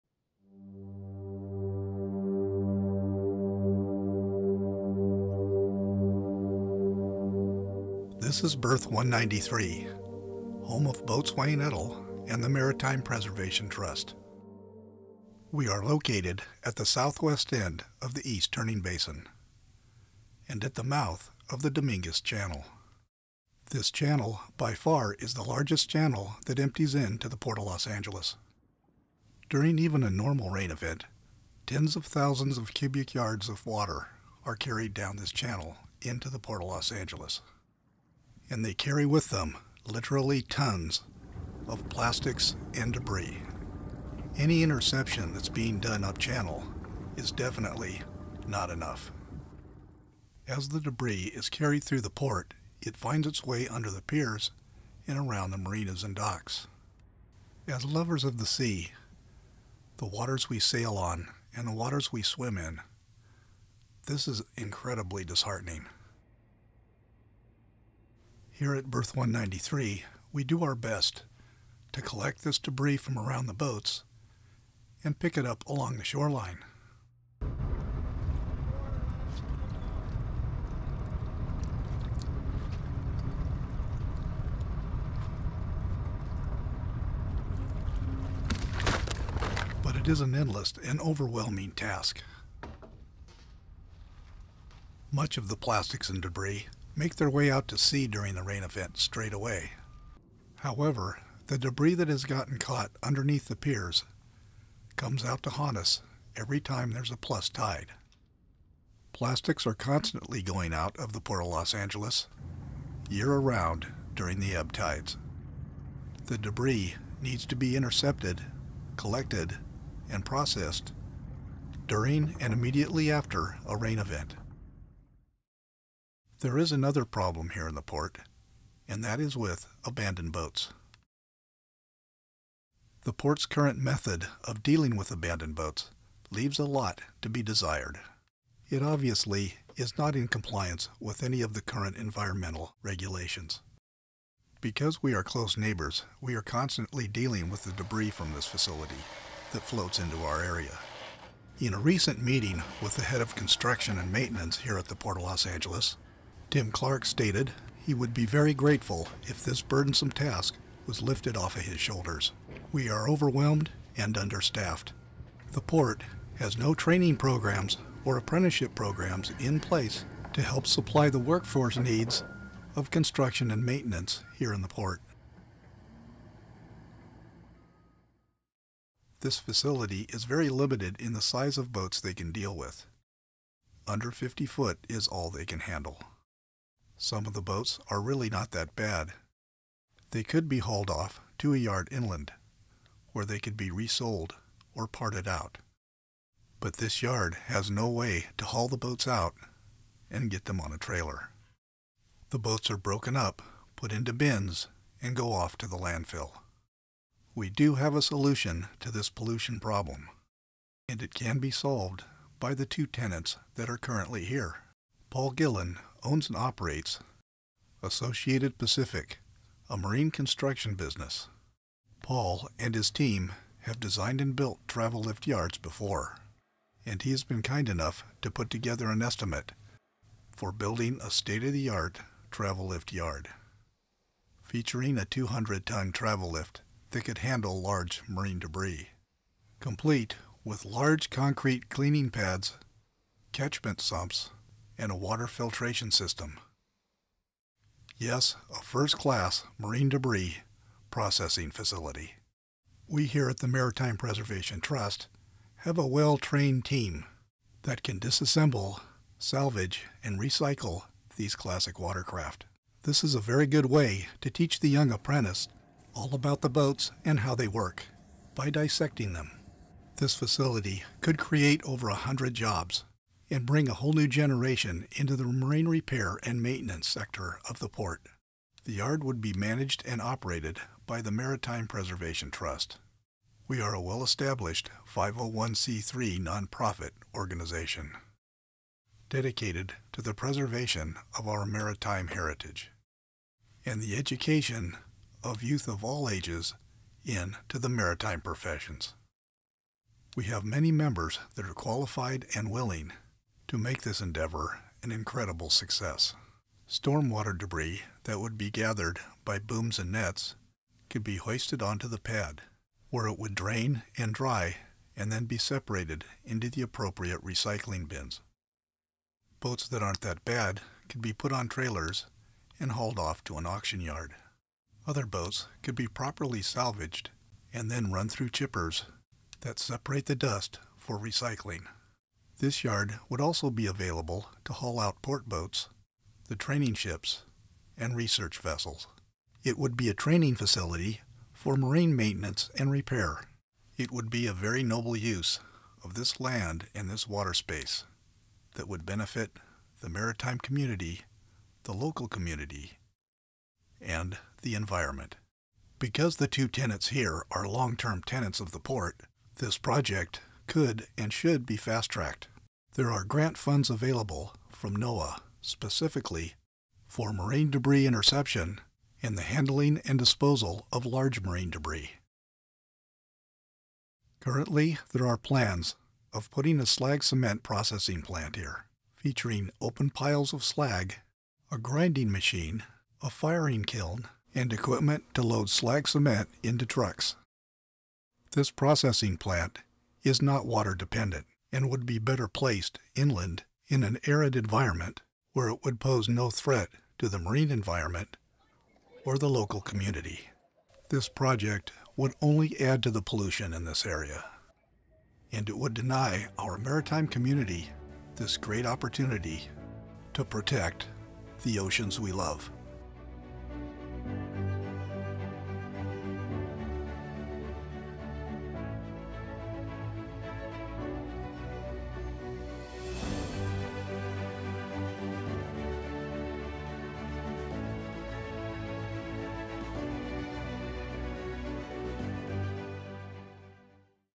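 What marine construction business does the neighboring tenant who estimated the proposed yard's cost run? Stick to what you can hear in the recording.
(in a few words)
Associated Pacific.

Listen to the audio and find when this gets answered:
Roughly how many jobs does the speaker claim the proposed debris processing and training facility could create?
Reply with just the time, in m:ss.
4:31.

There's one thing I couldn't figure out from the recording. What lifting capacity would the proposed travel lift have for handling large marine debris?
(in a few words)
200 tons.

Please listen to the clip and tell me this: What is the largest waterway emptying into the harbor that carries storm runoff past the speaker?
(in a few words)
Dominguez Channel.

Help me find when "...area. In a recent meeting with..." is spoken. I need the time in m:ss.
2:30.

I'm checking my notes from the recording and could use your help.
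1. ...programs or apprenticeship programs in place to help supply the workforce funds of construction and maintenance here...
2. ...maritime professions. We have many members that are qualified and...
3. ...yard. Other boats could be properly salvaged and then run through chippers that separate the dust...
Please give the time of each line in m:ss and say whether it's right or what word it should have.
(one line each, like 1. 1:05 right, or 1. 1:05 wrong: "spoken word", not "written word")
1. 2:47 wrong: "needs", not "funds"
2. 4:57 right
3. 5:23 right.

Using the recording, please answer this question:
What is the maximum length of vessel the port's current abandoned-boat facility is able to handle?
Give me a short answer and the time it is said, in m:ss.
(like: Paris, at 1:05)
50 feet, at 3:04.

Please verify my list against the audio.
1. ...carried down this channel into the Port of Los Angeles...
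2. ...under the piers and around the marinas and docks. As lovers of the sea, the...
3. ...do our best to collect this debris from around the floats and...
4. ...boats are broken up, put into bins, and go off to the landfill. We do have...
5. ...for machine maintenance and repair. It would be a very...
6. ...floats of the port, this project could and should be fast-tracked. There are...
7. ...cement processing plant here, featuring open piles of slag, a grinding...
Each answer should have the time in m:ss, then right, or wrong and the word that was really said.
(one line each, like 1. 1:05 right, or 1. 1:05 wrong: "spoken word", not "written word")
1. 0:34 right
2. 0:53 right
3. 1:10 wrong: "boats", not "floats"
4. 3:22 right
5. 5:41 wrong: "marine", not "machine"
6. 5:58 wrong: "tenants", not "floats"
7. 6:17 right.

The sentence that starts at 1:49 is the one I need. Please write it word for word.
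Plastics are constantly going out of the port of Los Angeles year around during the ebb tides.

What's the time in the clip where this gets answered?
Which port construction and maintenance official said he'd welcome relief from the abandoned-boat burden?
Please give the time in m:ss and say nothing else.
2:36.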